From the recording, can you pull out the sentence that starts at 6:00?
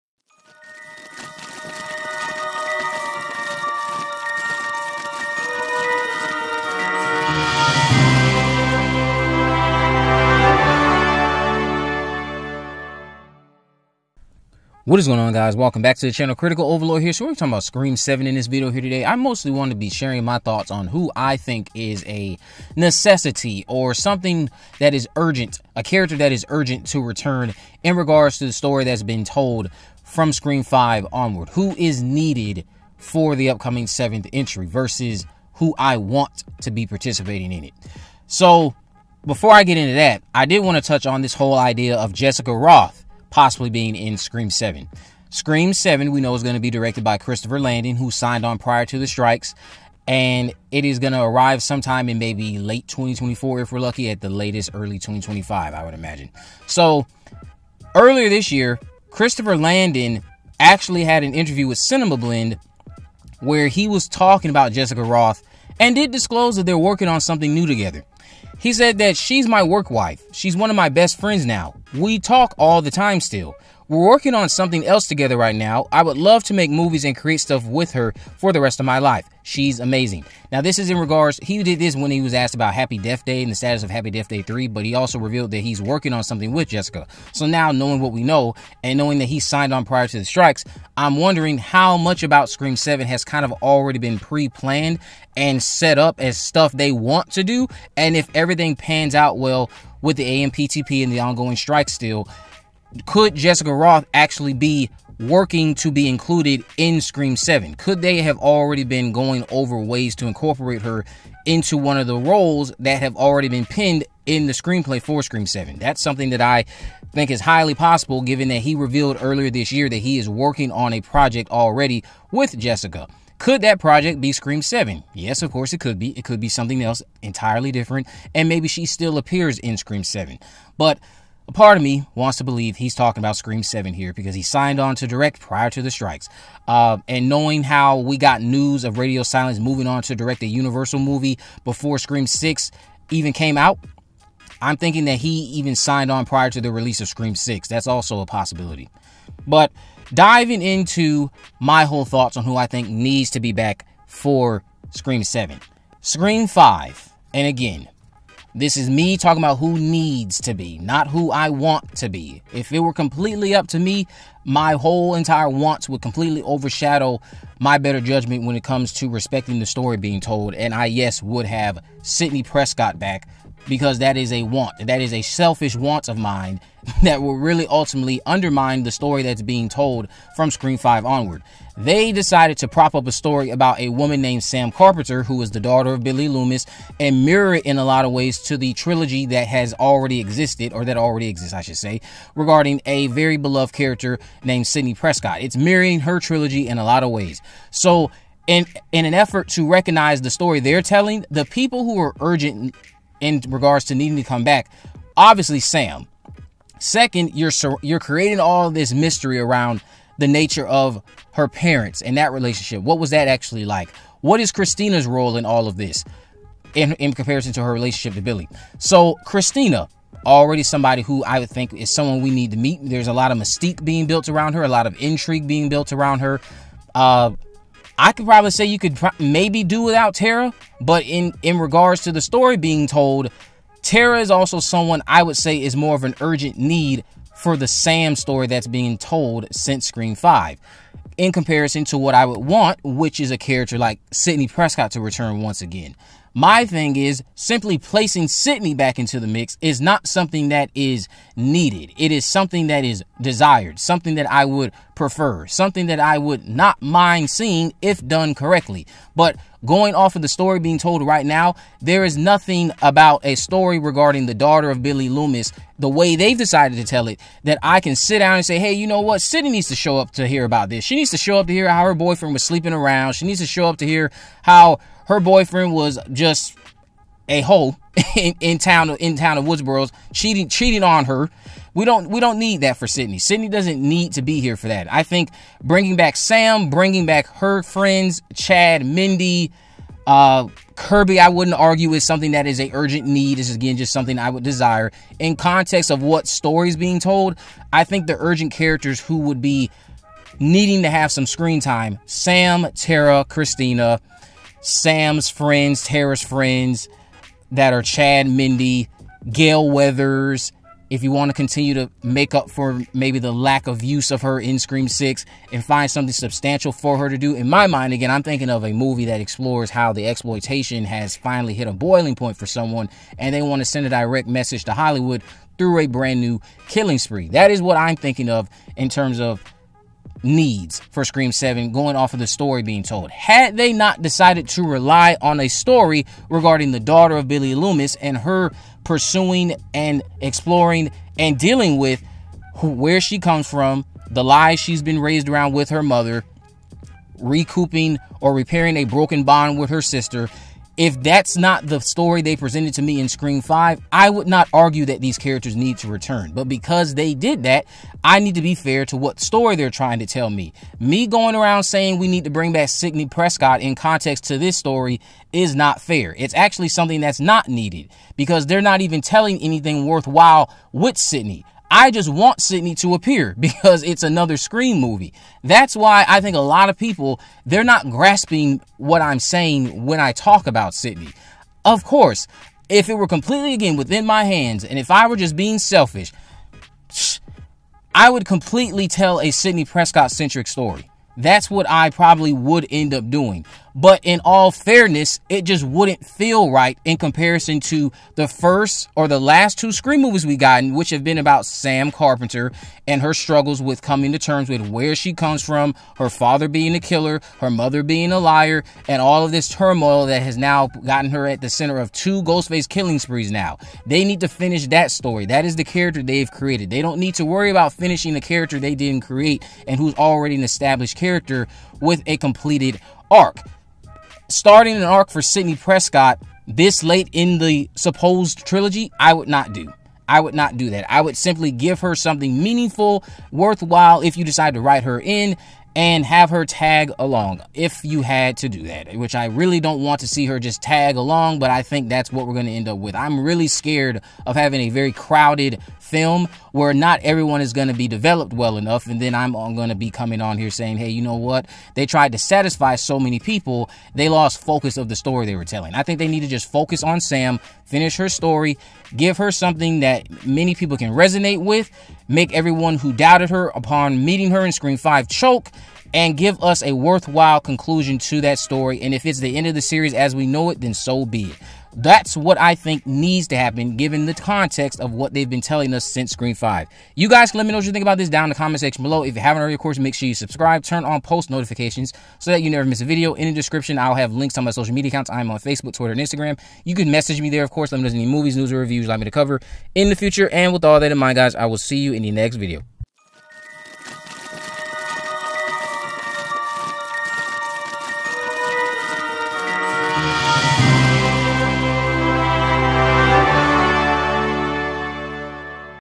Me going around saying we need to bring back Sidney Prescott in context to this story is not fair.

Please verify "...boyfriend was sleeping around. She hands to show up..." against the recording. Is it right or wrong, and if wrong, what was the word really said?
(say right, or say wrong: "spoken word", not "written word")
wrong: "needs", not "hands".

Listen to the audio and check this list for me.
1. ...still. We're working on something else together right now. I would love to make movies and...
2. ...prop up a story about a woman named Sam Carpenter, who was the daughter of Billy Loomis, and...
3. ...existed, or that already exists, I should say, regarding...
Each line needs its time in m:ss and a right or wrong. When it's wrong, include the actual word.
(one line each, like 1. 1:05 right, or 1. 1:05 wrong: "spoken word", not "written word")
1. 1:13 right
2. 3:02 right
3. 3:10 right.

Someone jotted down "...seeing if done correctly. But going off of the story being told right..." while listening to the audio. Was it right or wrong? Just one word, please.
right.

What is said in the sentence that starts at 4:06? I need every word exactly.
My thing is simply placing Sidney back into the mix is not something that is needed.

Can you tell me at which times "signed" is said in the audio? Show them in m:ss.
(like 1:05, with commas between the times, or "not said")
0:48, 1:29, 2:14, 2:25.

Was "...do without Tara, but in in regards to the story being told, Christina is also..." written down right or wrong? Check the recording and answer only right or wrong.
wrong.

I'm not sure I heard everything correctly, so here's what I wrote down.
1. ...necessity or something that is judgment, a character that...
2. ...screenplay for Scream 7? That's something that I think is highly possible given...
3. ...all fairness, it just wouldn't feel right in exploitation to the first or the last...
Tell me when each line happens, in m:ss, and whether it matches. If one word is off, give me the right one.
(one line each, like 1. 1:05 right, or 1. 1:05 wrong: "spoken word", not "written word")
1. 0:22 wrong: "urgent", not "judgment"
2. 1:54 right
3. 6:34 wrong: "comparison", not "exploitation".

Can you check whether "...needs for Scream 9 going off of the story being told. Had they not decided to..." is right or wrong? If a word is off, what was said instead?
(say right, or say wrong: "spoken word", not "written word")
wrong: "7", not "9".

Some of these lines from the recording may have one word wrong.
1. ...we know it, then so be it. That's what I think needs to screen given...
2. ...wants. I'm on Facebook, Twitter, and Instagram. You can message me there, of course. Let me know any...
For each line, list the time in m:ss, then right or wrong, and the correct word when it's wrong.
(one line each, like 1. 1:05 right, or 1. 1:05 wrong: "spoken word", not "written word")
1. 7:50 wrong: "happen", not "screen"
2. 8:04 wrong: "accounts", not "wants".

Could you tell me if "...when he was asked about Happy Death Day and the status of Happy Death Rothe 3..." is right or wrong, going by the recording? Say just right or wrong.
wrong.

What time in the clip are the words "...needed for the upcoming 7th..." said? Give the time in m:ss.
0:32.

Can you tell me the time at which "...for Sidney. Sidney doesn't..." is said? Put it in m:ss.
4:42.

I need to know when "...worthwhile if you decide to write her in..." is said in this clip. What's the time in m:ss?
7:13.